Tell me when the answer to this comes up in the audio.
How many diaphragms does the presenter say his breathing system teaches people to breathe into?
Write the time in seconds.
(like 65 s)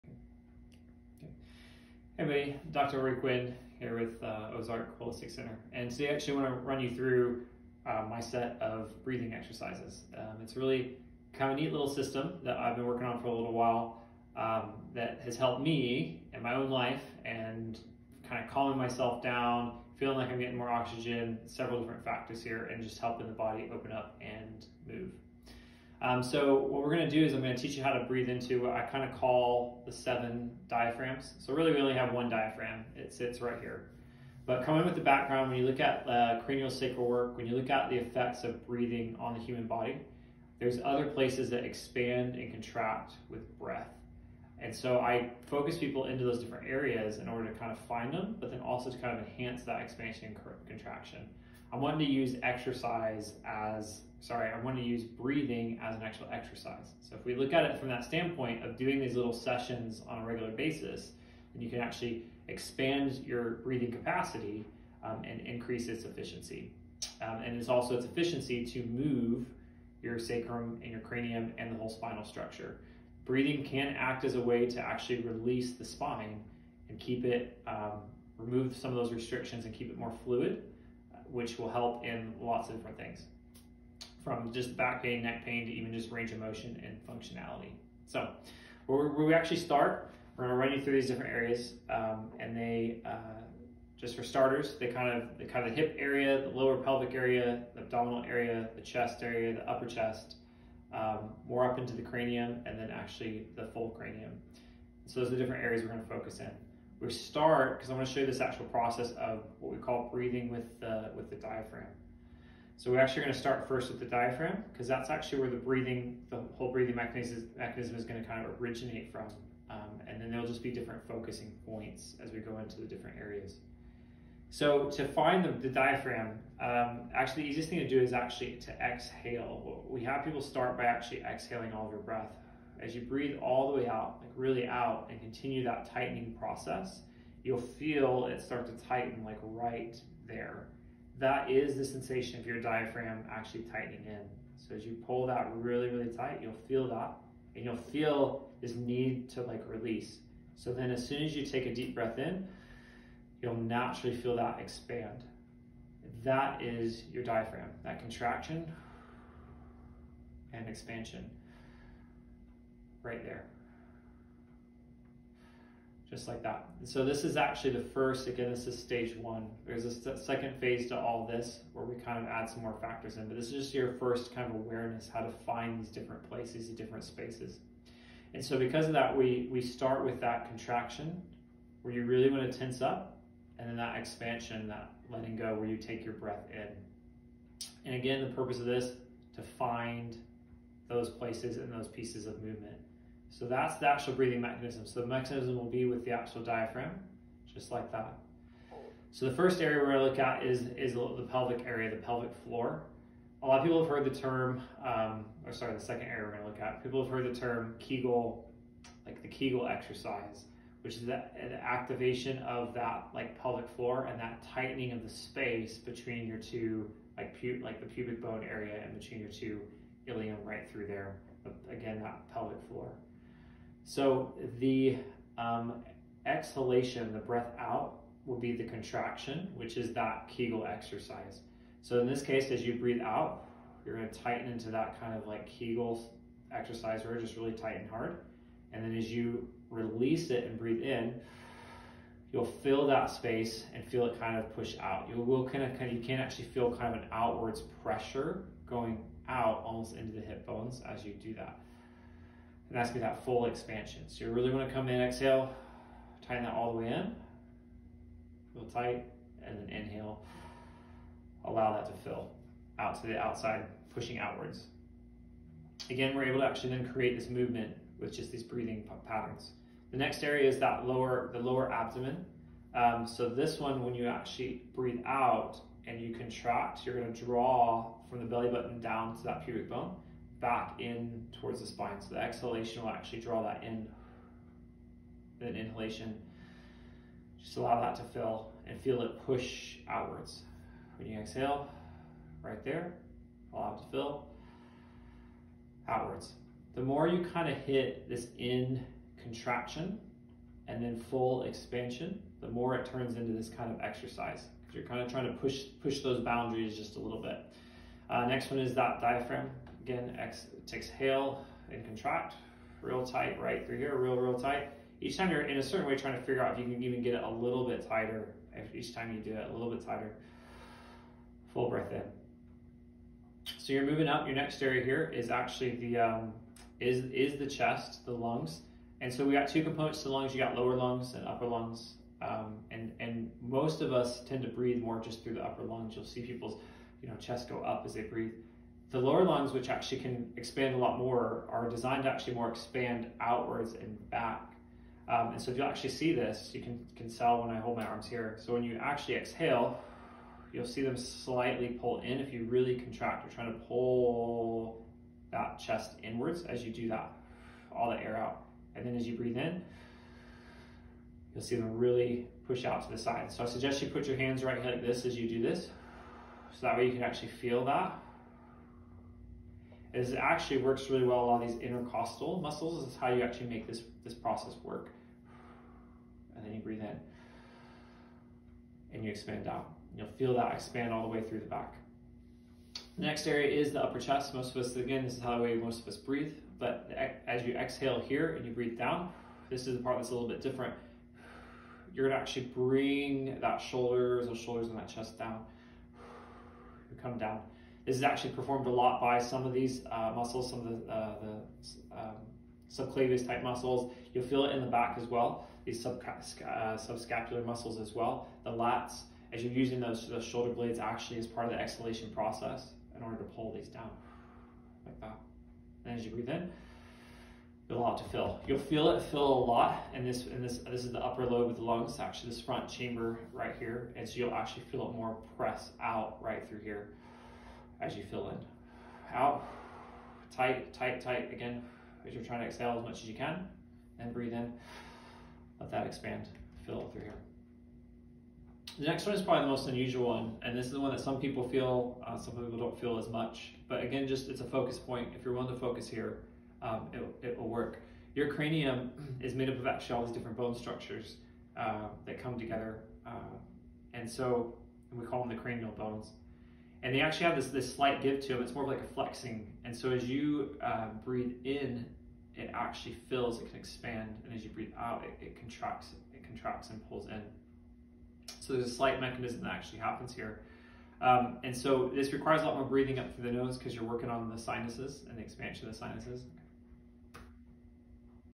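29 s.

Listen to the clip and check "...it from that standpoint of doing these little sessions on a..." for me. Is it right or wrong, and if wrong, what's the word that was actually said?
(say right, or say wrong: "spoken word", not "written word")
right.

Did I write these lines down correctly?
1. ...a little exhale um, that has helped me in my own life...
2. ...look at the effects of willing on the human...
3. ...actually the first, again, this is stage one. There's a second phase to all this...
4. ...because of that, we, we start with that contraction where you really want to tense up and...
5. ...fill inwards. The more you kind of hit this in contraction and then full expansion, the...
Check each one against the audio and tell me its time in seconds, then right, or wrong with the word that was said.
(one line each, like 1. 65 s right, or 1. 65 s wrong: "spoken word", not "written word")
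1. 13 s wrong: "while", not "exhale"
2. 37 s wrong: "breathing", not "willing"
3. 167 s right
4. 178 s right
5. 293 s wrong: "outwards", not "inwards".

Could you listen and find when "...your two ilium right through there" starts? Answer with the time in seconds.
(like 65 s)
219 s.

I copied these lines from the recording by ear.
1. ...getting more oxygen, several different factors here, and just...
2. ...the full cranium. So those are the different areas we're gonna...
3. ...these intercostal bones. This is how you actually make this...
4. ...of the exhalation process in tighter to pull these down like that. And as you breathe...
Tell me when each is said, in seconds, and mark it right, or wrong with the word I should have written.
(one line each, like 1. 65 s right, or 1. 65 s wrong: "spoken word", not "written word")
1. 20 s right
2. 103 s right
3. 371 s wrong: "muscles", not "bones"
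4. 411 s wrong: "order", not "tighter".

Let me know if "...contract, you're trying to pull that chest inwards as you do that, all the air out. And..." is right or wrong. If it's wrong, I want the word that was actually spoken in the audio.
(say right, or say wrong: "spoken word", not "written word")
right.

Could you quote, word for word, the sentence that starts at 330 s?
You got lower lungs and upper lungs.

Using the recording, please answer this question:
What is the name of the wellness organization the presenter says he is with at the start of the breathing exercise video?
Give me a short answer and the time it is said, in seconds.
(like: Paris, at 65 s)
Ozark Holistic Center, at 4 s.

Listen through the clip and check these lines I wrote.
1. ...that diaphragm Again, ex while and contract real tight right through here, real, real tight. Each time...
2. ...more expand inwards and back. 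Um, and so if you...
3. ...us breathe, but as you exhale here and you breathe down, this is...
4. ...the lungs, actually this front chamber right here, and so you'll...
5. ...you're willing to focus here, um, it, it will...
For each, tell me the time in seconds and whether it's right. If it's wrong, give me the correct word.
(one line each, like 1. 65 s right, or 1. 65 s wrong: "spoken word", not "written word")
1. 308 s wrong: "exhale", not "while"
2. 342 s wrong: "outwards", not "inwards"
3. 385 s right
4. 421 s right
5. 445 s right.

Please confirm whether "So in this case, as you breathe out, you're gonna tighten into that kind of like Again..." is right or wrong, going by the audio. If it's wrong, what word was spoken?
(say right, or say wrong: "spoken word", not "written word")
wrong: "Kegel", not "Again".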